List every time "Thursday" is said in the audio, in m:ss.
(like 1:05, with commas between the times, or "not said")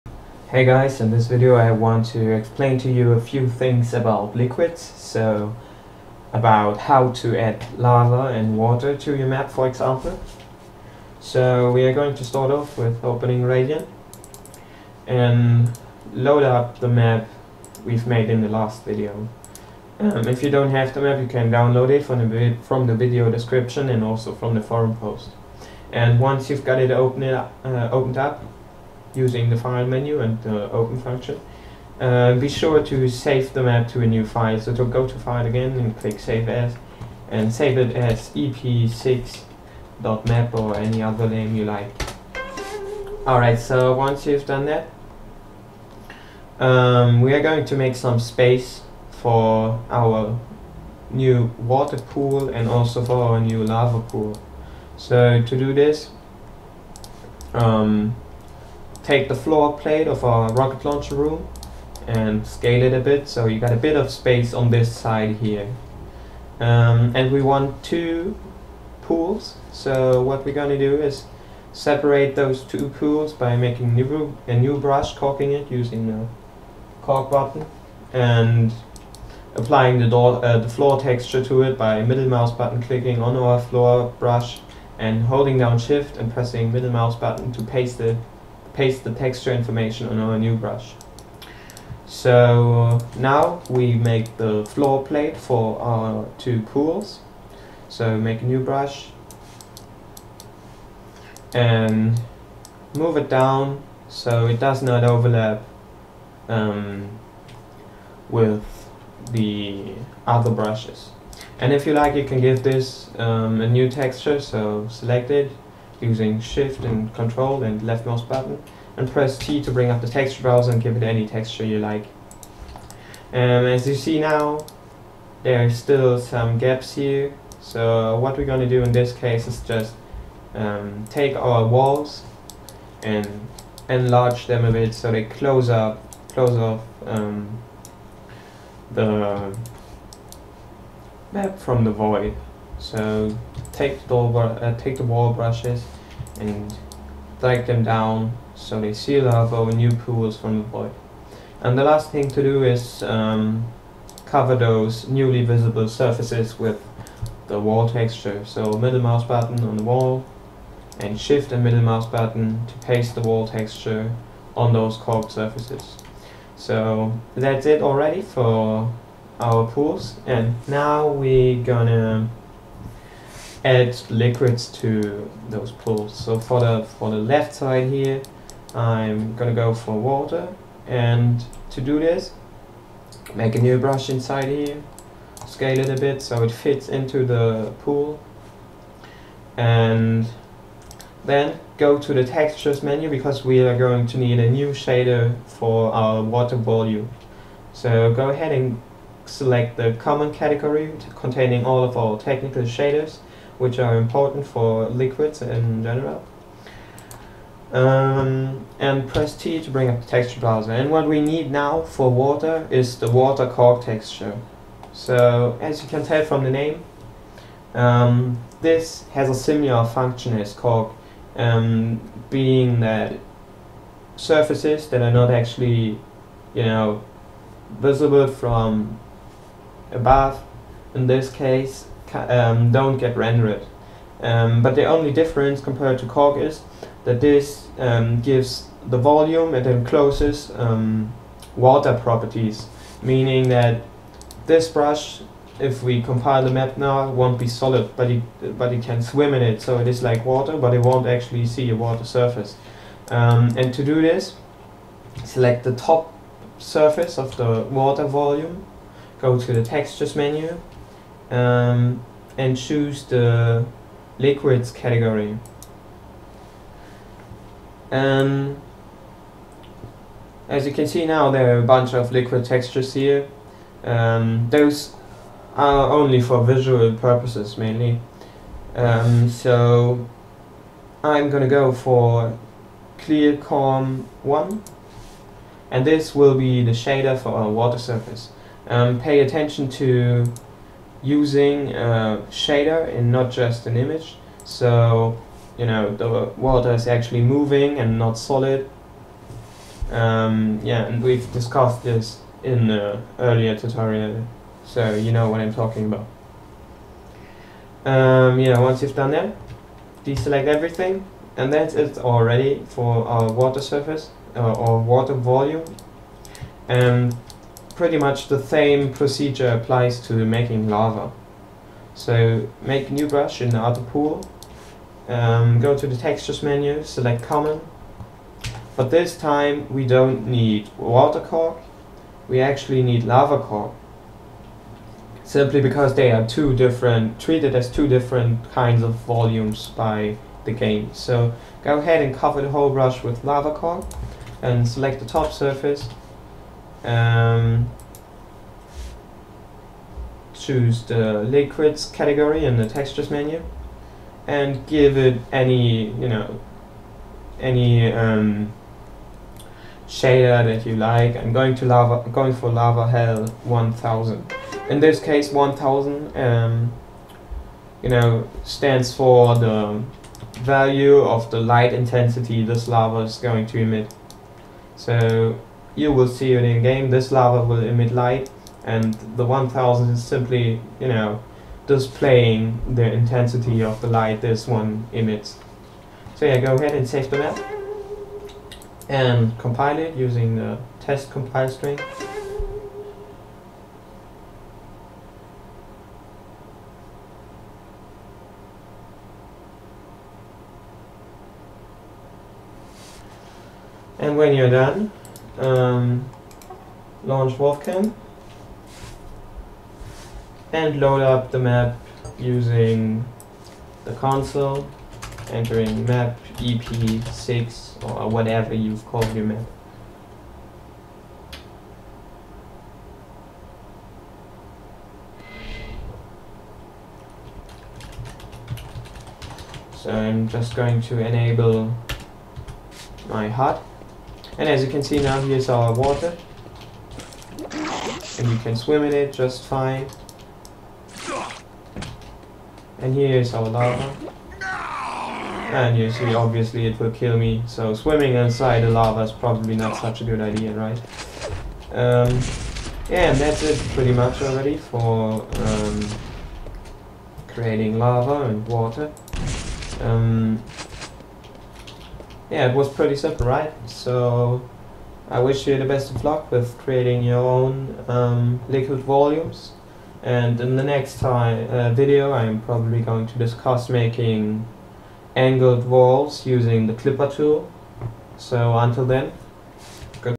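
not said.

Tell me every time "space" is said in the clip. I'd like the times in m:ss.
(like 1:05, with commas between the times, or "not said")
0:48, 1:04.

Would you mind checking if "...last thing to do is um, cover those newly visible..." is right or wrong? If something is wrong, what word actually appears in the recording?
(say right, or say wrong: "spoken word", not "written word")
right.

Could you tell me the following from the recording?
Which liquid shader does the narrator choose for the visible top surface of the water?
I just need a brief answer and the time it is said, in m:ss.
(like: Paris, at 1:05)
clear calm 1, at 4:42.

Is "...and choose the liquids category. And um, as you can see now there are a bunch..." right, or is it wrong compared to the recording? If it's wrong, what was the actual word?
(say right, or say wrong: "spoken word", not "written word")
right.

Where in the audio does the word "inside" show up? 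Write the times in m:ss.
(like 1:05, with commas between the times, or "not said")
3:04, 7:28.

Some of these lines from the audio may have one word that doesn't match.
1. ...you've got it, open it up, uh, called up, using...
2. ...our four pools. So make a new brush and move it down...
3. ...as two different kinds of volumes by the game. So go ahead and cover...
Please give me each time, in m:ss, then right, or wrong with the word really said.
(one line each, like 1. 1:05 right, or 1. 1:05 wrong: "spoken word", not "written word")
1. 0:26 wrong: "opened", not "called"
2. 1:35 wrong: "two", not "four"
3. 5:37 right.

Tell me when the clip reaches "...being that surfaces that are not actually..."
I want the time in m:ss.
3:42.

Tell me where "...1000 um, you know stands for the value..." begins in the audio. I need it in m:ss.
6:05.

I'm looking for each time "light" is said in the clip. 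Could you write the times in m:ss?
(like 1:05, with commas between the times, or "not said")
6:11, 6:17, 6:23.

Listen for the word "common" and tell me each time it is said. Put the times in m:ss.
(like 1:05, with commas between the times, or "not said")
3:19, 5:27.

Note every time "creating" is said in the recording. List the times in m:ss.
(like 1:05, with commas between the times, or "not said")
7:37, 7:46.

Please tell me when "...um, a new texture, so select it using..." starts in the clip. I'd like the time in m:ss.
1:53.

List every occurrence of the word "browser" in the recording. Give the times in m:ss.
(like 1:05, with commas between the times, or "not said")
2:00, 3:30.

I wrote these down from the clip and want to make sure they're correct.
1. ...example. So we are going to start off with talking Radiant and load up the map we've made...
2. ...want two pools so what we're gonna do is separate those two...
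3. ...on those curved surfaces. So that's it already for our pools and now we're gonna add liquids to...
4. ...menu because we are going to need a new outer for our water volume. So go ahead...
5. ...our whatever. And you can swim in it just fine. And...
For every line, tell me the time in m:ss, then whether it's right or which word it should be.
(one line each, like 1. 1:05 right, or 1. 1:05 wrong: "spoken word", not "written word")
1. 0:09 wrong: "opening", not "talking"
2. 1:07 right
3. 2:44 right
4. 3:12 wrong: "shader", not "outer"
5. 7:15 wrong: "water", not "whatever".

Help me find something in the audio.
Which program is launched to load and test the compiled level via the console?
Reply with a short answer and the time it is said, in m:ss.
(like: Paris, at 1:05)
WolfCam, at 6:47.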